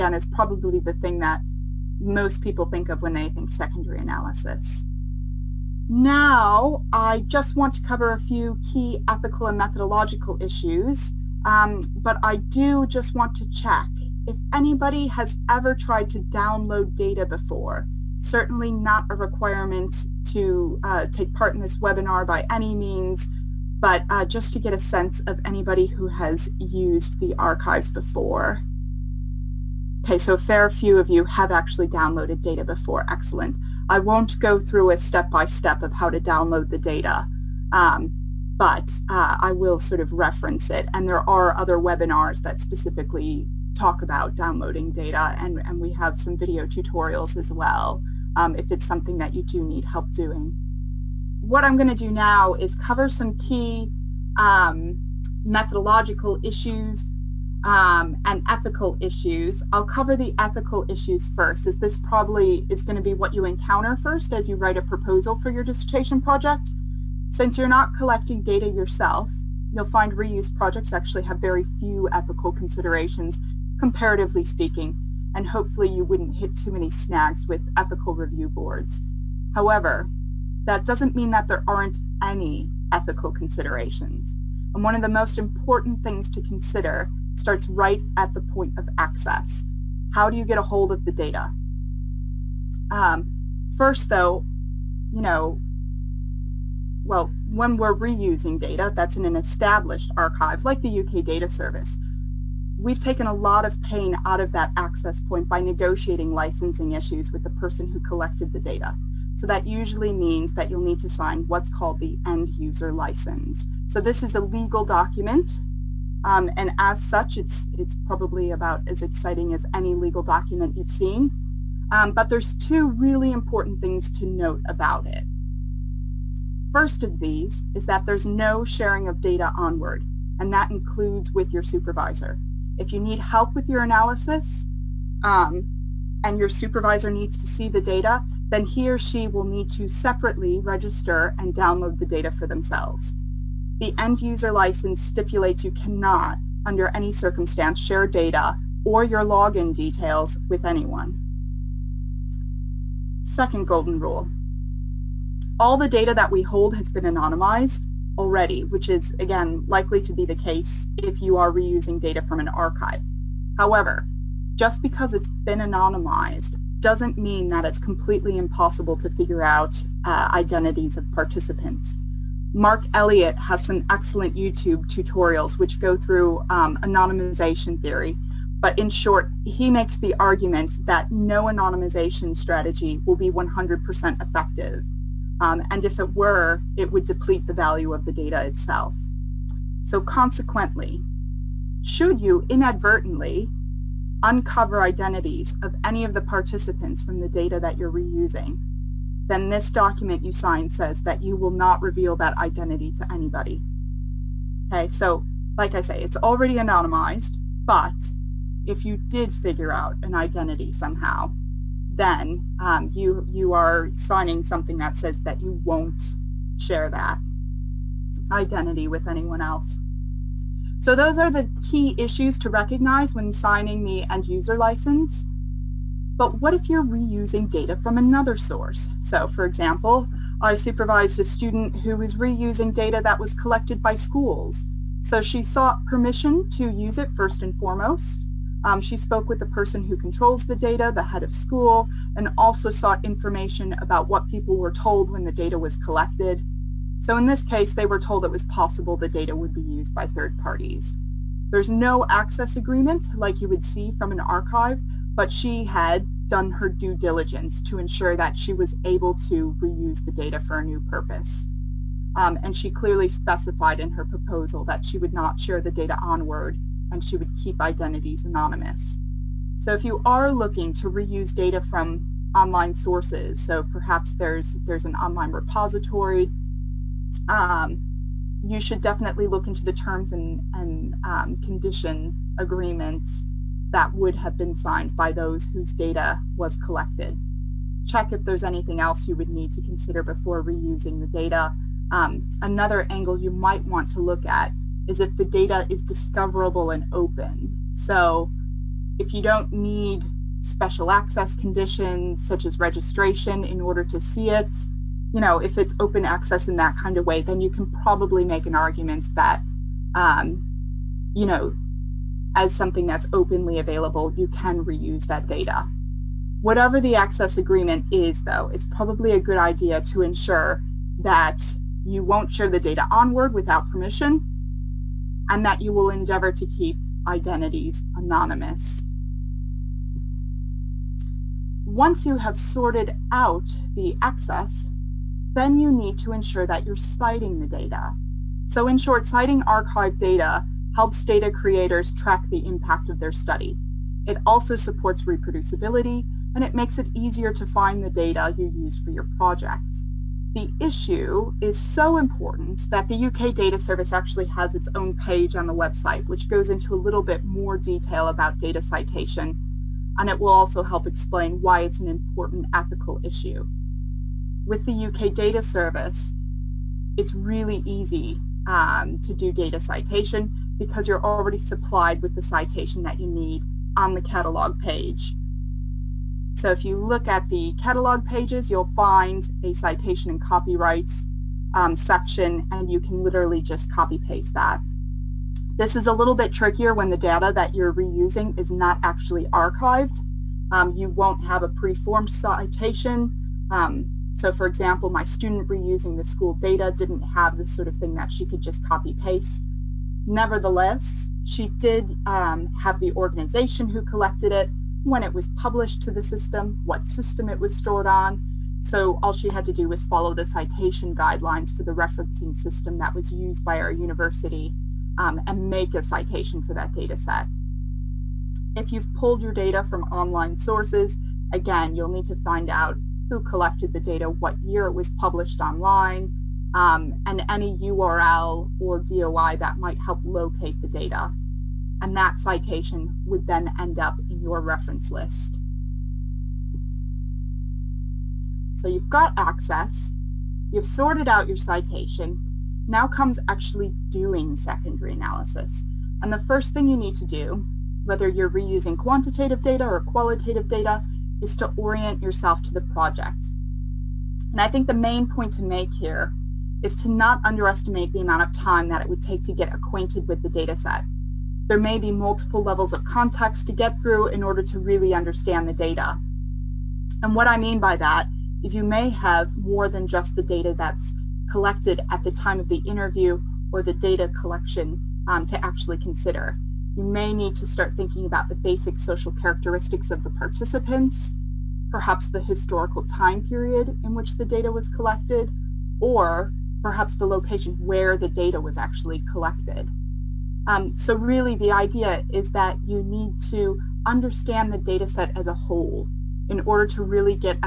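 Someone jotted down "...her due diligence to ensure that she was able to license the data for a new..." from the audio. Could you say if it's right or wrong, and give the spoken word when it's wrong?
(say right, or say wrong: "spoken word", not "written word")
wrong: "reuse", not "license".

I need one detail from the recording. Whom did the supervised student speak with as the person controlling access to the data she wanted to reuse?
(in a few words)
head of school.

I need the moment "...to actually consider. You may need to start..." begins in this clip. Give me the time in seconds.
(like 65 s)
475 s.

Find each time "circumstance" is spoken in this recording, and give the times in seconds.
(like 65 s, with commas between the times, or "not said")
147 s.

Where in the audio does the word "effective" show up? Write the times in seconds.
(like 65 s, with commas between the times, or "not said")
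184 s.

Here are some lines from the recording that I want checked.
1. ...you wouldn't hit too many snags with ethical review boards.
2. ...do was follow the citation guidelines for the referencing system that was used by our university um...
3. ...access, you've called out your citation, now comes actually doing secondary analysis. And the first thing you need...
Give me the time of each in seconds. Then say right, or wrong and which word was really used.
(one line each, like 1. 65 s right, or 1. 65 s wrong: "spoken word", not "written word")
1. 75 s right
2. 409 s right
3. 439 s wrong: "sorted", not "called".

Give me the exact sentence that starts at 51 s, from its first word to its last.
What I'm going to do now is cover some key um, methodological issues um, and ethical issues.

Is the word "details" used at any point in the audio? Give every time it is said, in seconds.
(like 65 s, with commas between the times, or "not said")
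149 s, 357 s.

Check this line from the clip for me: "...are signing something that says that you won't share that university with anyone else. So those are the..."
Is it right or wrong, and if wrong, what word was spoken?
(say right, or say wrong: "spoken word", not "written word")
wrong: "identity", not "university".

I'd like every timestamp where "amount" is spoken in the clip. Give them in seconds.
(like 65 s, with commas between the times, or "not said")
458 s.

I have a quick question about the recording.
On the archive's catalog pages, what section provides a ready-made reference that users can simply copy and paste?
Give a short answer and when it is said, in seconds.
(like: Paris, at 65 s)
citation and copyright, at 379 s.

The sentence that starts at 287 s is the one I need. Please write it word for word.
Check if there's anything else you would need to consider before reusing the data.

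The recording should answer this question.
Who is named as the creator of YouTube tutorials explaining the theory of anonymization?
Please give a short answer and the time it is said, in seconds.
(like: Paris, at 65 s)
Mark Elliot, at 172 s.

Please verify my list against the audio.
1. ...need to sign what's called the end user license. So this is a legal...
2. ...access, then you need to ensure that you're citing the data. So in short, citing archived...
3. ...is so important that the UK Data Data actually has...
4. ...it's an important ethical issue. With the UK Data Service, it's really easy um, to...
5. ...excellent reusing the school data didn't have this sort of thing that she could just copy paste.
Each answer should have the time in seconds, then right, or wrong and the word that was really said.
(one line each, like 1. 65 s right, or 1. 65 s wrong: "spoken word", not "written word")
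1. 110 s right
2. 334 s right
3. 351 s wrong: "Service", not "Data"
4. 361 s right
5. 395 s wrong: "student", not "excellent".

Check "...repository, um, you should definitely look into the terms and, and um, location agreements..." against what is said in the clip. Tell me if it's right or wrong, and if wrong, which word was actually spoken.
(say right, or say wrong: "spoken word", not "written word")
wrong: "condition", not "location".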